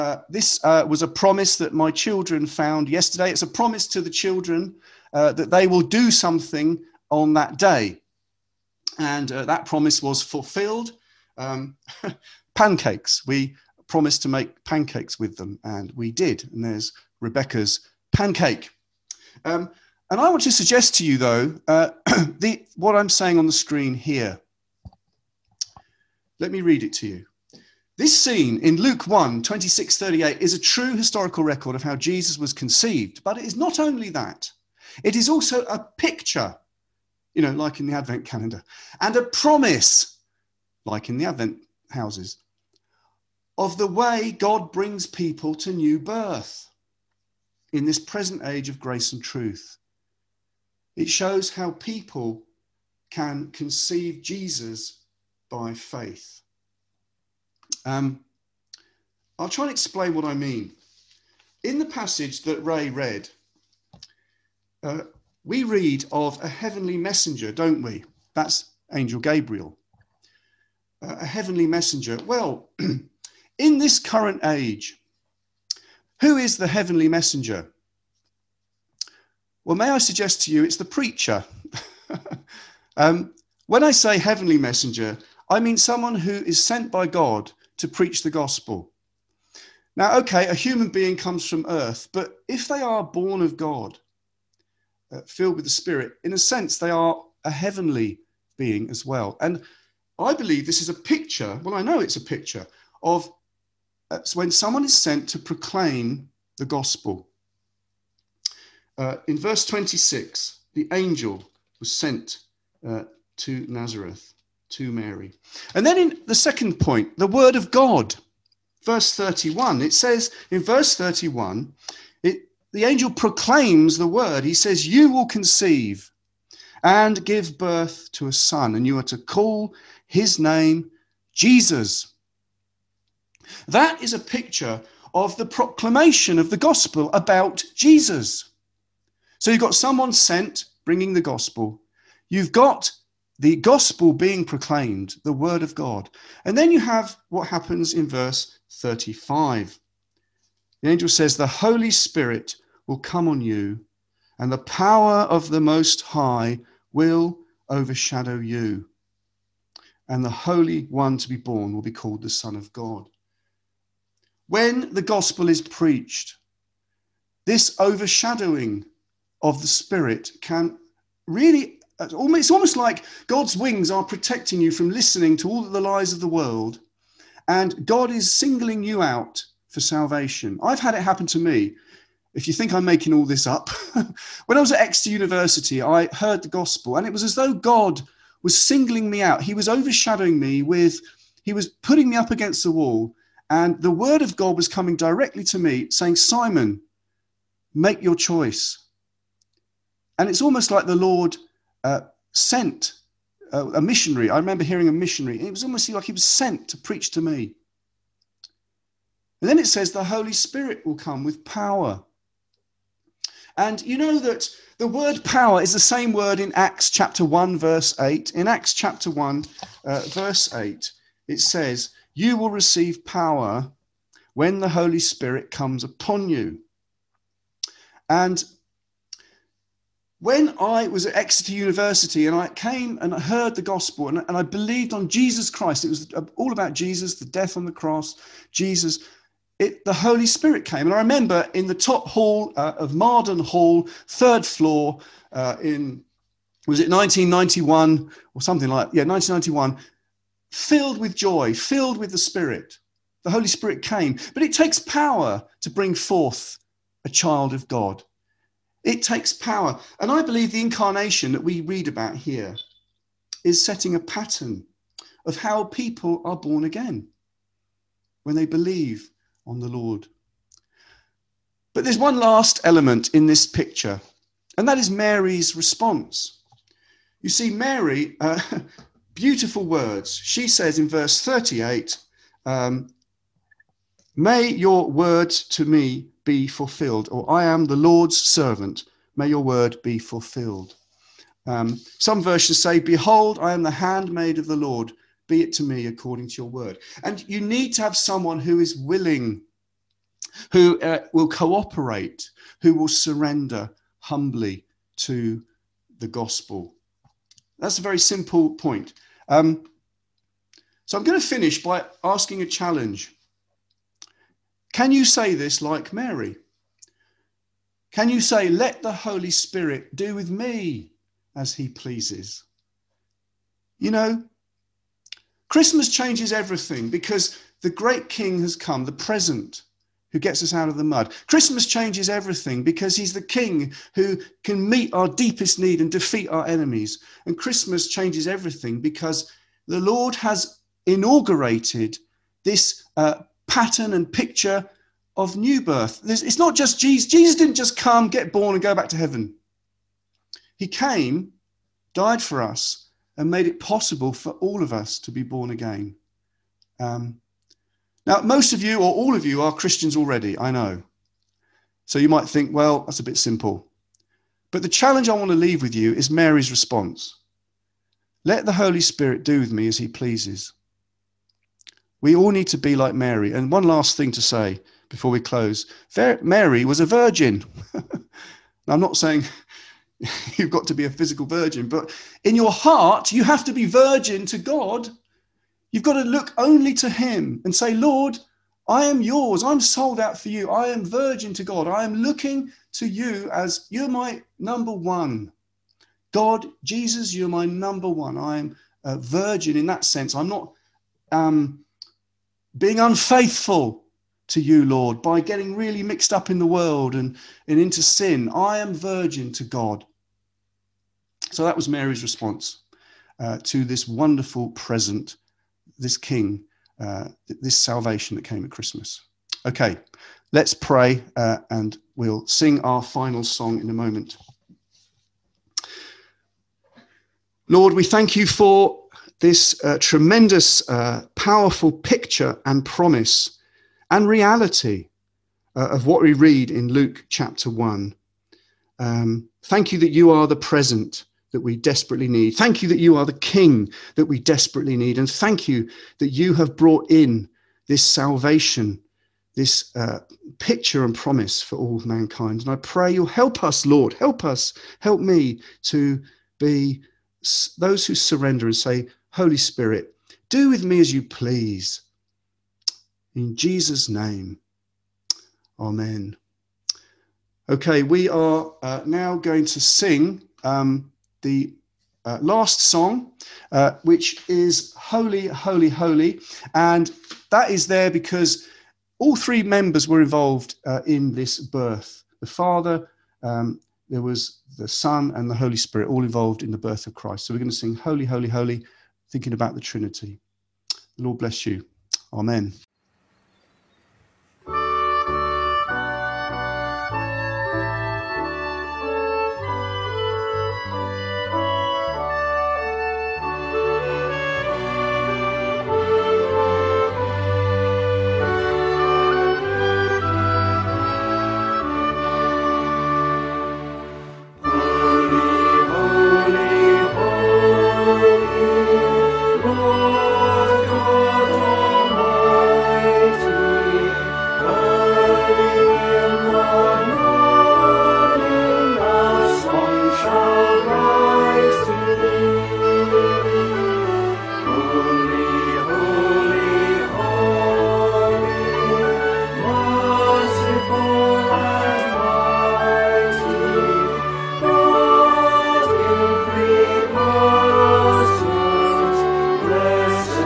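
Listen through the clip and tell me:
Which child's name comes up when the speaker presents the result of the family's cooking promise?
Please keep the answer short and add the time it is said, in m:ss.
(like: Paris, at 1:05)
Rebecca, at 0:17.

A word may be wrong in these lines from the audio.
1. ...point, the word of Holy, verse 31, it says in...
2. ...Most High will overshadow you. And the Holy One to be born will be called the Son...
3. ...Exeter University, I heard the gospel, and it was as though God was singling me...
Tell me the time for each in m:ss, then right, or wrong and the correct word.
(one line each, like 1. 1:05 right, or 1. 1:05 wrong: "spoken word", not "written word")
1. 1:56 wrong: "God", not "Holy"
2. 2:35 right
3. 3:04 right.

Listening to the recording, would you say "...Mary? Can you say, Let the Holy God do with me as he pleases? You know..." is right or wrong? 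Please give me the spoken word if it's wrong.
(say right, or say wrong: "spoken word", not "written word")
wrong: "Spirit", not "God".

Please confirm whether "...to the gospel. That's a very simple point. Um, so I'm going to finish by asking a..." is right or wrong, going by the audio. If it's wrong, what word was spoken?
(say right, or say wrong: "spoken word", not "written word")
right.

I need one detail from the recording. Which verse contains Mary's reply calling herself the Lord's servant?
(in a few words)
Verse 38.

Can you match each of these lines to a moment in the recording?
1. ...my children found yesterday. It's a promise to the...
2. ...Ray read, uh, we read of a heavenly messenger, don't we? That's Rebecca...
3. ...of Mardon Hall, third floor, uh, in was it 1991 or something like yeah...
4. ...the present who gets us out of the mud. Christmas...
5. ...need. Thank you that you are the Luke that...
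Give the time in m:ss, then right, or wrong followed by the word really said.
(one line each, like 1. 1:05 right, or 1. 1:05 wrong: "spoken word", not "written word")
1. 0:01 right
2. 1:02 wrong: "Angel", not "Rebecca"
3. 4:02 right
4. 5:28 right
5. 7:22 wrong: "King", not "Luke".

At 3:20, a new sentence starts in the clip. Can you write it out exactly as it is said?
And it's almost like the Lord uh, sent uh, a missionary.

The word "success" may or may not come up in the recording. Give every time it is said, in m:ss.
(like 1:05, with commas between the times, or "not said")
not said.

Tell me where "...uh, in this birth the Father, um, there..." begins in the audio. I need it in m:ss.
8:00.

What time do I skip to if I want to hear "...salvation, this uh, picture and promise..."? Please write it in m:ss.
7:27.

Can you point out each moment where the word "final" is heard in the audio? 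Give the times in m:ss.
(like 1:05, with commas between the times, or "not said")
7:02.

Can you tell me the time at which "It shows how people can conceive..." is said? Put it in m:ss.
0:50.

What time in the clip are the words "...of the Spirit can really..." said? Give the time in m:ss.
2:49.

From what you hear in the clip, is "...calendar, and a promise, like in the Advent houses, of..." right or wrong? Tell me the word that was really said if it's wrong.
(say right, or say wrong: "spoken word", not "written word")
right.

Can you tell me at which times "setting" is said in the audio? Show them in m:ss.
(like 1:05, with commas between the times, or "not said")
4:23.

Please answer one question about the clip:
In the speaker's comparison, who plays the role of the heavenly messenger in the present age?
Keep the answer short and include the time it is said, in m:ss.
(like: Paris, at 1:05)
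The preacher, at 1:20.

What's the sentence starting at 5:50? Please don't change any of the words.
He came, died for us, and made it possible for all of us to be born again.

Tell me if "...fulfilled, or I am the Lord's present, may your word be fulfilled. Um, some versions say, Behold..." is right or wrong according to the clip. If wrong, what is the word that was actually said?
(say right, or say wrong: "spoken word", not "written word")
wrong: "servant", not "present".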